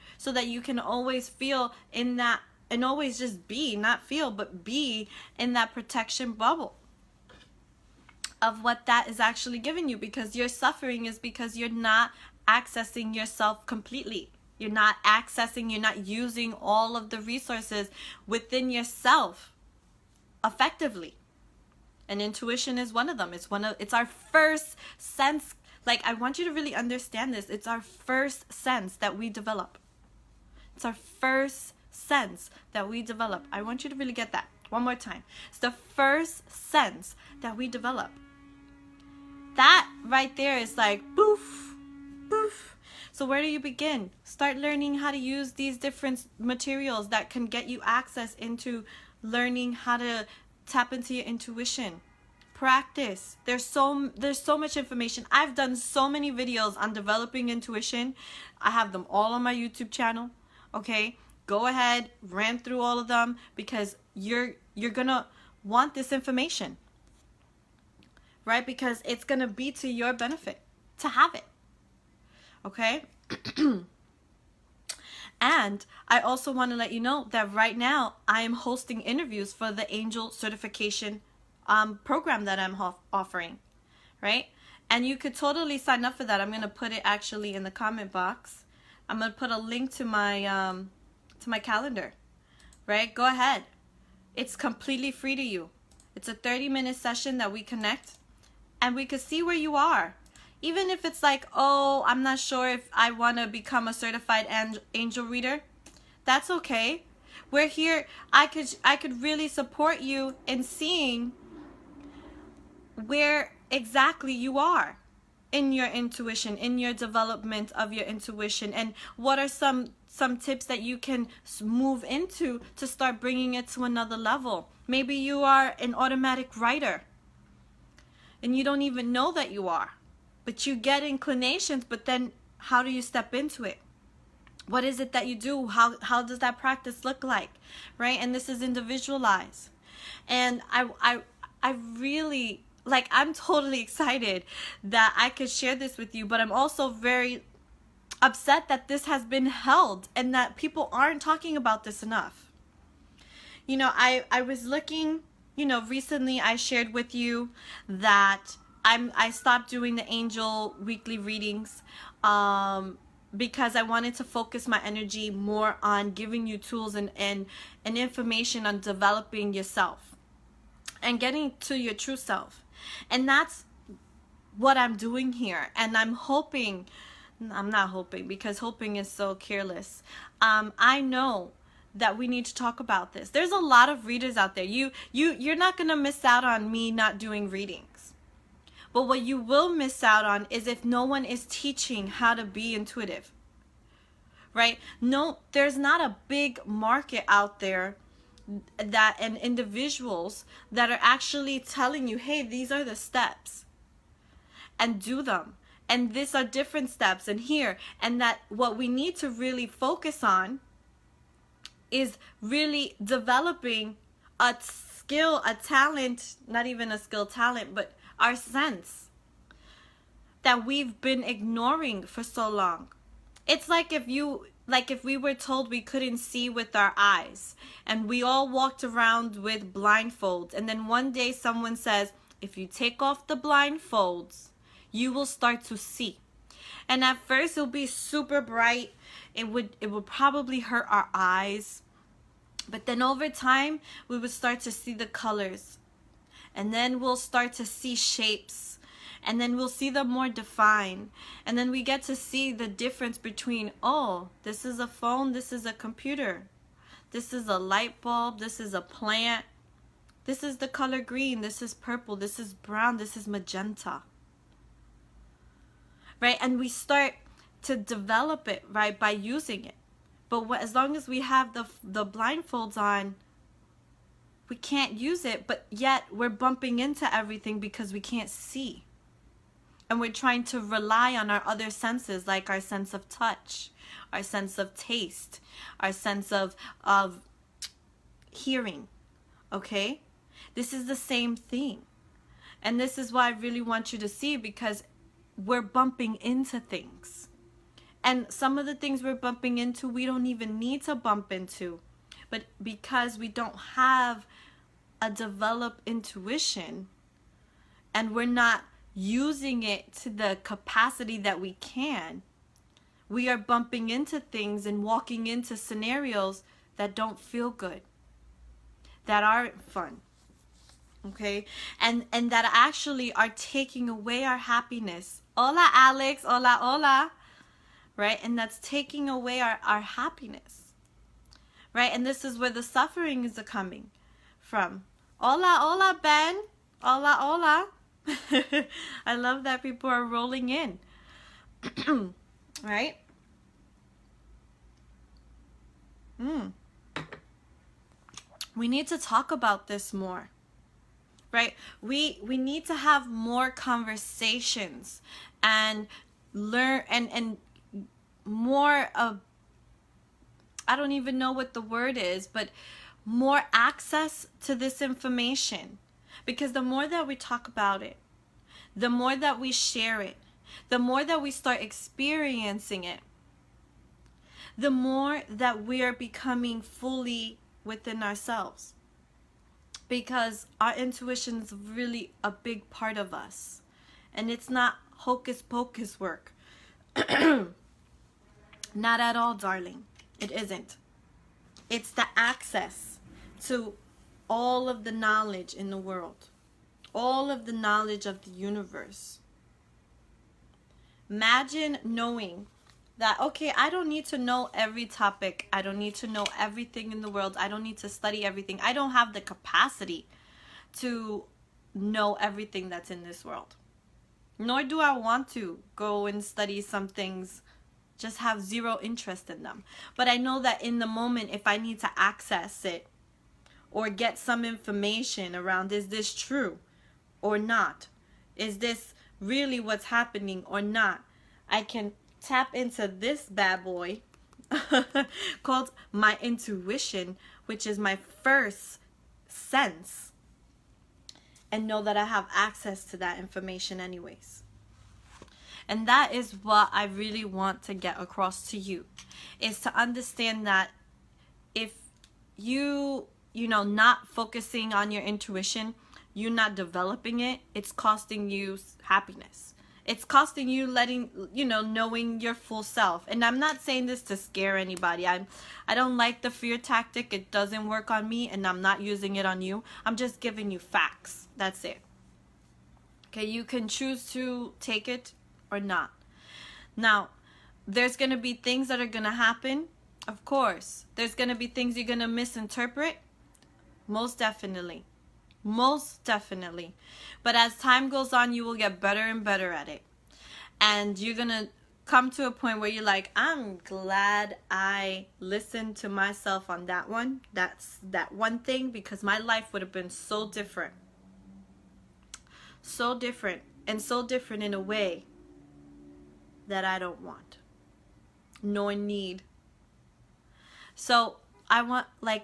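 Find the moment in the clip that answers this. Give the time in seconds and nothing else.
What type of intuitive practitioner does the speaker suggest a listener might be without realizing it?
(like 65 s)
125 s.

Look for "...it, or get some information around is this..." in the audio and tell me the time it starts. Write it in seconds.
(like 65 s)
422 s.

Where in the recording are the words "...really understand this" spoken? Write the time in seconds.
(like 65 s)
26 s.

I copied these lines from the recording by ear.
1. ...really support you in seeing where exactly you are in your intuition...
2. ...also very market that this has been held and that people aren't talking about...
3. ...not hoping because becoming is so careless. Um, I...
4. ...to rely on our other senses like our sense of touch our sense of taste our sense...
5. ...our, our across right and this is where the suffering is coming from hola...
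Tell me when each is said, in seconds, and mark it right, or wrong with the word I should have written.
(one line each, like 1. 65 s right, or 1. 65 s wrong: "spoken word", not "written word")
1. 109 s right
2. 146 s wrong: "upset", not "market"
3. 177 s wrong: "hoping", not "becoming"
4. 280 s right
5. 329 s wrong: "happiness", not "across".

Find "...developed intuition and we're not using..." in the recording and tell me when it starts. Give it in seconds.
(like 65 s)
305 s.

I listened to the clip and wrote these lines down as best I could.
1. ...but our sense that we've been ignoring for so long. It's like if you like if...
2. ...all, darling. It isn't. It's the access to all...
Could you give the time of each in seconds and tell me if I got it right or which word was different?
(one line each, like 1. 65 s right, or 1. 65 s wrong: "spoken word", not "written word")
1. 217 s right
2. 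389 s right.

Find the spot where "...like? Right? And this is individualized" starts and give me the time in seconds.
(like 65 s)
137 s.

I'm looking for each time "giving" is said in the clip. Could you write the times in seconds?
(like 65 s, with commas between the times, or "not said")
9 s, 166 s, 470 s.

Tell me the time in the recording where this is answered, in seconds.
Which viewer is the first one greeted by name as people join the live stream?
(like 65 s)
325 s.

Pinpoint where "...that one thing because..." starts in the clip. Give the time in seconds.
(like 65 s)
497 s.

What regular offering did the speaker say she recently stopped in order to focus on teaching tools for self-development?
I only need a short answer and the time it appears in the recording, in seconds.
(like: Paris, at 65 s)
Angel weekly readings, at 160 s.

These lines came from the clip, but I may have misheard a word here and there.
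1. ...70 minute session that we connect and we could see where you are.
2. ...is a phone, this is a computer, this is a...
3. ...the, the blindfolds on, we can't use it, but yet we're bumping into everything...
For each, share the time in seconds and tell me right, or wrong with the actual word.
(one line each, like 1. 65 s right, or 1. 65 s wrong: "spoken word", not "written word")
1. 96 s wrong: "30", not "70"
2. 254 s right
3. 271 s right.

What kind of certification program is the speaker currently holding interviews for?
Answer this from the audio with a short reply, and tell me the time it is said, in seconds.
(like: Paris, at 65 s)
Angel certification, at 79 s.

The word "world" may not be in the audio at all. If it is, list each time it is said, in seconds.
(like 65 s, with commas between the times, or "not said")
395 s, 407 s, 413 s.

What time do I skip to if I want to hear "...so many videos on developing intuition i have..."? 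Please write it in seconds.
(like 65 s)
55 s.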